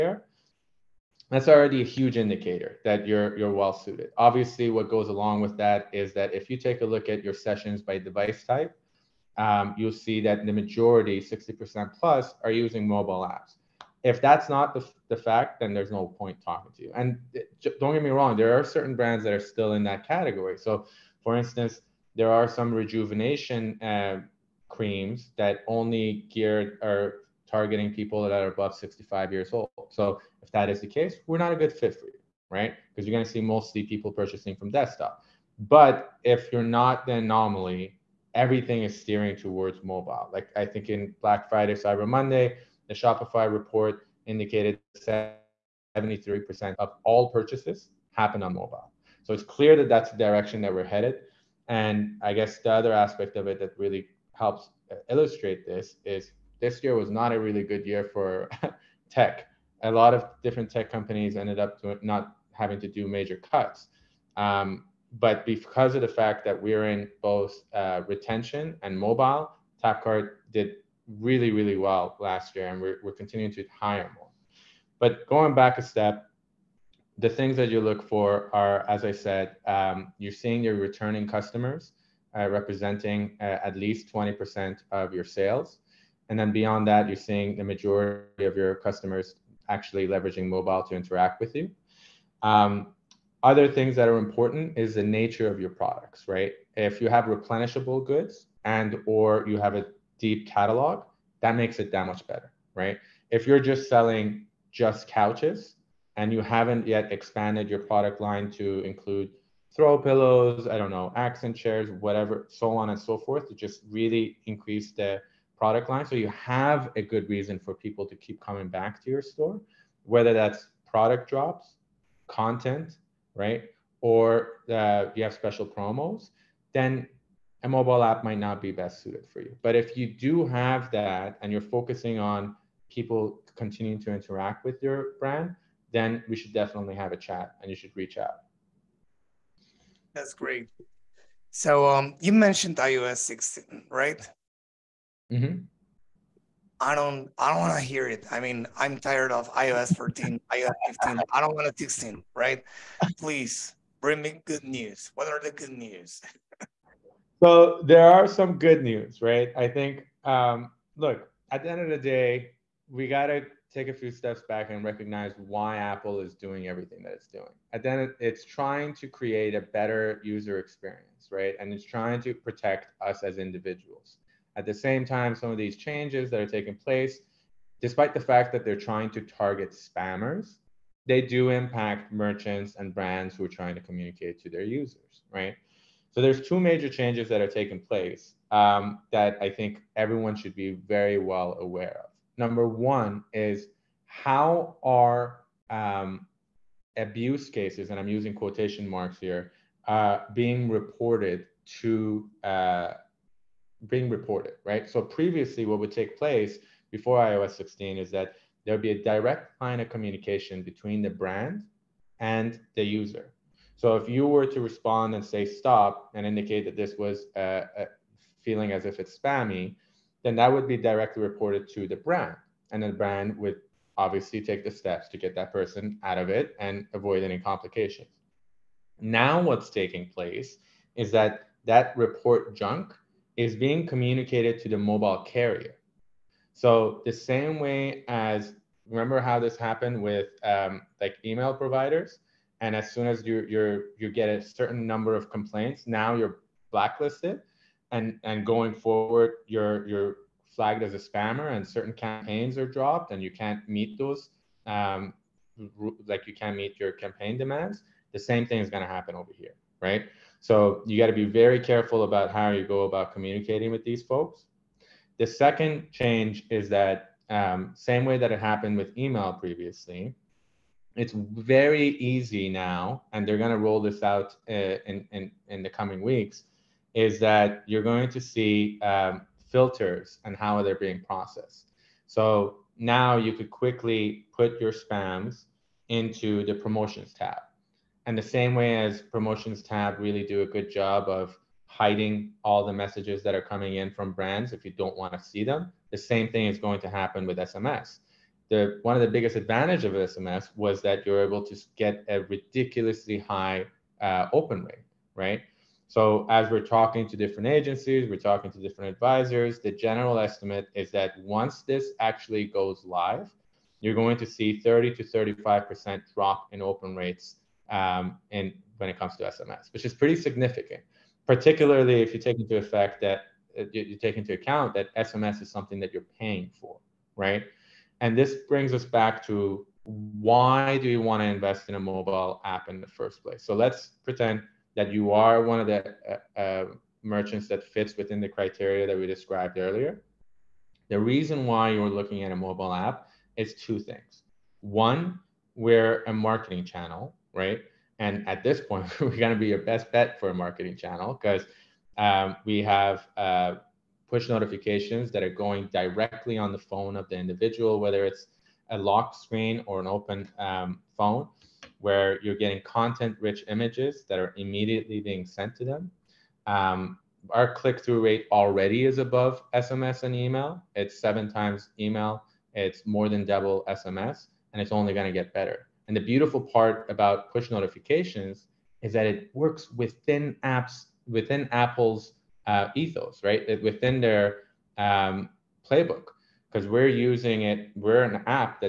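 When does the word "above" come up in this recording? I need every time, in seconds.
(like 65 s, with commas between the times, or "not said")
28 s, 368 s.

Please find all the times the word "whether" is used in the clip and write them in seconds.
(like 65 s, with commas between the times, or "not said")
120 s, 357 s.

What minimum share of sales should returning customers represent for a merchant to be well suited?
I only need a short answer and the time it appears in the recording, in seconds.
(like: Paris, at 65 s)
20%, at 84 s.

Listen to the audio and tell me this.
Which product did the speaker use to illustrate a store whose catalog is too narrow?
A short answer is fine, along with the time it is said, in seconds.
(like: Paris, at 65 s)
couches, at 105 s.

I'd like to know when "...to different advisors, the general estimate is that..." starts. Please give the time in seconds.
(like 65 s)
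308 s.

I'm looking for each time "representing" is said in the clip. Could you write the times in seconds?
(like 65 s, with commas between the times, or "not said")
82 s.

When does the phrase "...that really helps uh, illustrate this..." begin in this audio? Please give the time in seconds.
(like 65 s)
53 s.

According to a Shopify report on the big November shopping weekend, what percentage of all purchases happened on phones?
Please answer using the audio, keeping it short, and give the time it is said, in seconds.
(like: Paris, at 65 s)
73%, at 45 s.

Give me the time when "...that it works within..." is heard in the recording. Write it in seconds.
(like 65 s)
378 s.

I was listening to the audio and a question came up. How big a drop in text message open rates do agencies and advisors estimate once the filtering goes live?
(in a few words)
30 to 35%.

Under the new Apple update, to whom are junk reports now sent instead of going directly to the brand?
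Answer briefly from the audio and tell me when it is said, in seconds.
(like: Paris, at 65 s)
the mobile carrier, at 234 s.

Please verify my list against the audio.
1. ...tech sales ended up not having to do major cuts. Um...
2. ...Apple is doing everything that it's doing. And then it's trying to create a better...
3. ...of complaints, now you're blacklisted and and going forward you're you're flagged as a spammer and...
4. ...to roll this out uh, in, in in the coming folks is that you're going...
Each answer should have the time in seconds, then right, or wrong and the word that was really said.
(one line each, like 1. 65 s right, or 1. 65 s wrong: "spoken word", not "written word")
1. 60 s wrong: "companies", not "sales"
2. 165 s right
3. 245 s right
4. 273 s wrong: "weeks", not "folks".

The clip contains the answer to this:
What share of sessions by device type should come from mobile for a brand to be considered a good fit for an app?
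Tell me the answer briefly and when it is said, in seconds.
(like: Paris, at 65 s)
60% plus, at 11 s.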